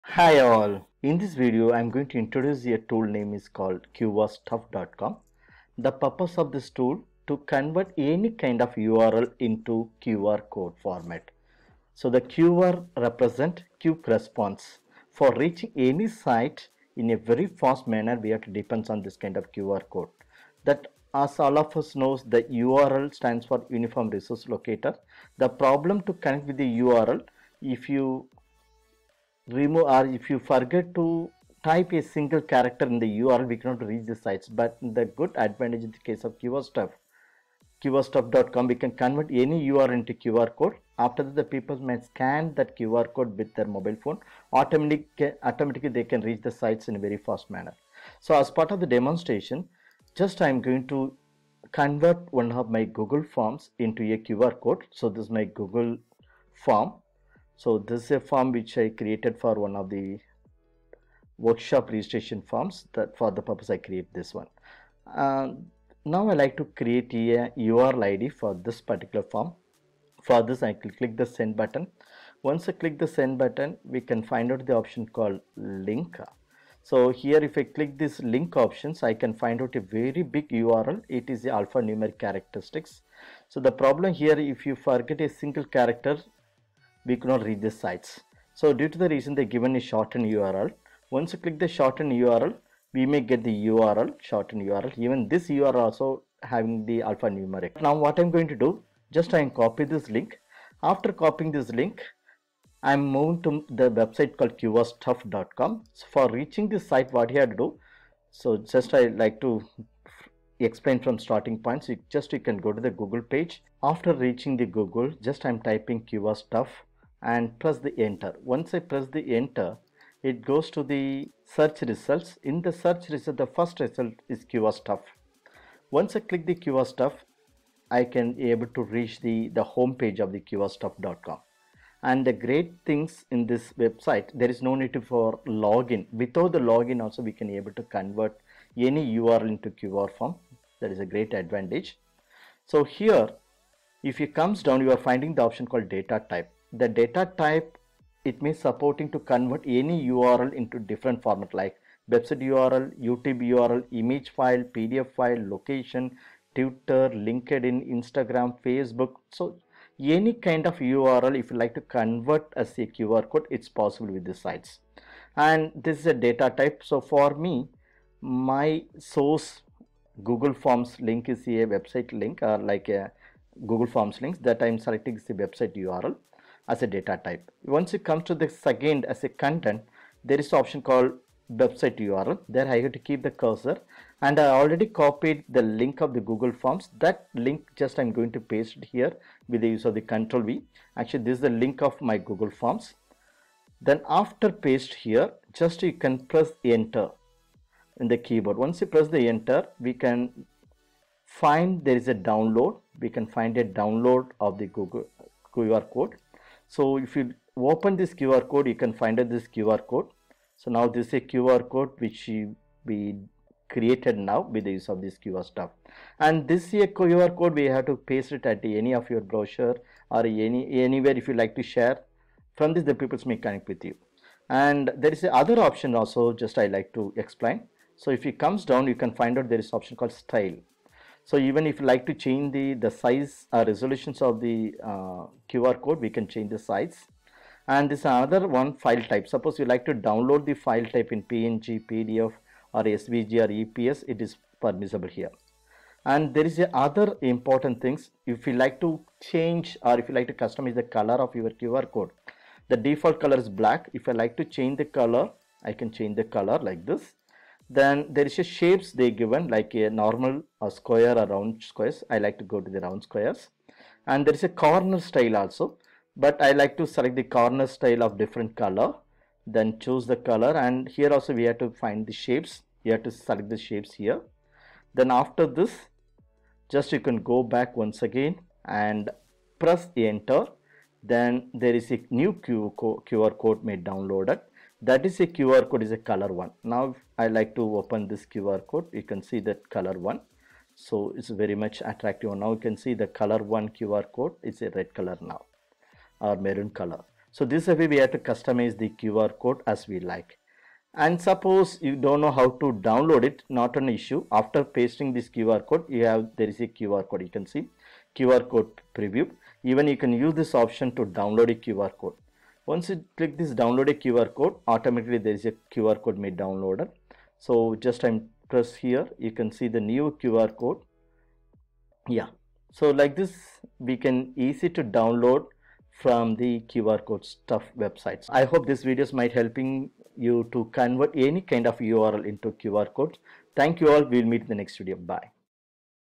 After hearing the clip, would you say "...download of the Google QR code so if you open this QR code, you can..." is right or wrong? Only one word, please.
right.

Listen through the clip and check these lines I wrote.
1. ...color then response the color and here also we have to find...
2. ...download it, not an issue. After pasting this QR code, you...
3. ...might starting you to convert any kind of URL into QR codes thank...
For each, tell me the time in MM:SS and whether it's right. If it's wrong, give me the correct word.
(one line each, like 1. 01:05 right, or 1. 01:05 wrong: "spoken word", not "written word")
1. 04:28 wrong: "choose", not "response"
2. 05:02 right
3. 05:29 wrong: "helping", not "starting".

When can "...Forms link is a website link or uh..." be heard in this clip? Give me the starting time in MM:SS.
02:50.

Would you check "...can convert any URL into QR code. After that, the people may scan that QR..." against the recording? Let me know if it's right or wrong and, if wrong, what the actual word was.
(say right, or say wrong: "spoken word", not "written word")
right.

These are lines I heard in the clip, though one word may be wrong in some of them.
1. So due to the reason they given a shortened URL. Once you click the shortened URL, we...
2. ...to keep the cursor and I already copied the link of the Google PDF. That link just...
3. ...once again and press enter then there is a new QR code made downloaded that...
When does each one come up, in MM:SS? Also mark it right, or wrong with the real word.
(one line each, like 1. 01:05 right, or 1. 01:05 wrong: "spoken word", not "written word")
1. 01:28 right
2. 03:02 wrong: "Forms", not "PDF"
3. 04:37 right.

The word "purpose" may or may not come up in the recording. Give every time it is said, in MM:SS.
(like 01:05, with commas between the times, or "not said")
00:05, 01:03.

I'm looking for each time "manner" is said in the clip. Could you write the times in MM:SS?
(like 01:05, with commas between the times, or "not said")
00:17, 00:47.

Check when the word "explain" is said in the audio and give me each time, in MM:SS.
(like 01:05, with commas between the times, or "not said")
01:50, 03:47.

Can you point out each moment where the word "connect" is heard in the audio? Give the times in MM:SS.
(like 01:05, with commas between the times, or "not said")
00:26, 03:43.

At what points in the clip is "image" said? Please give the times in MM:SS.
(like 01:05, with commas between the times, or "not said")
02:33.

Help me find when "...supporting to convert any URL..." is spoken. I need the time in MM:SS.
02:28.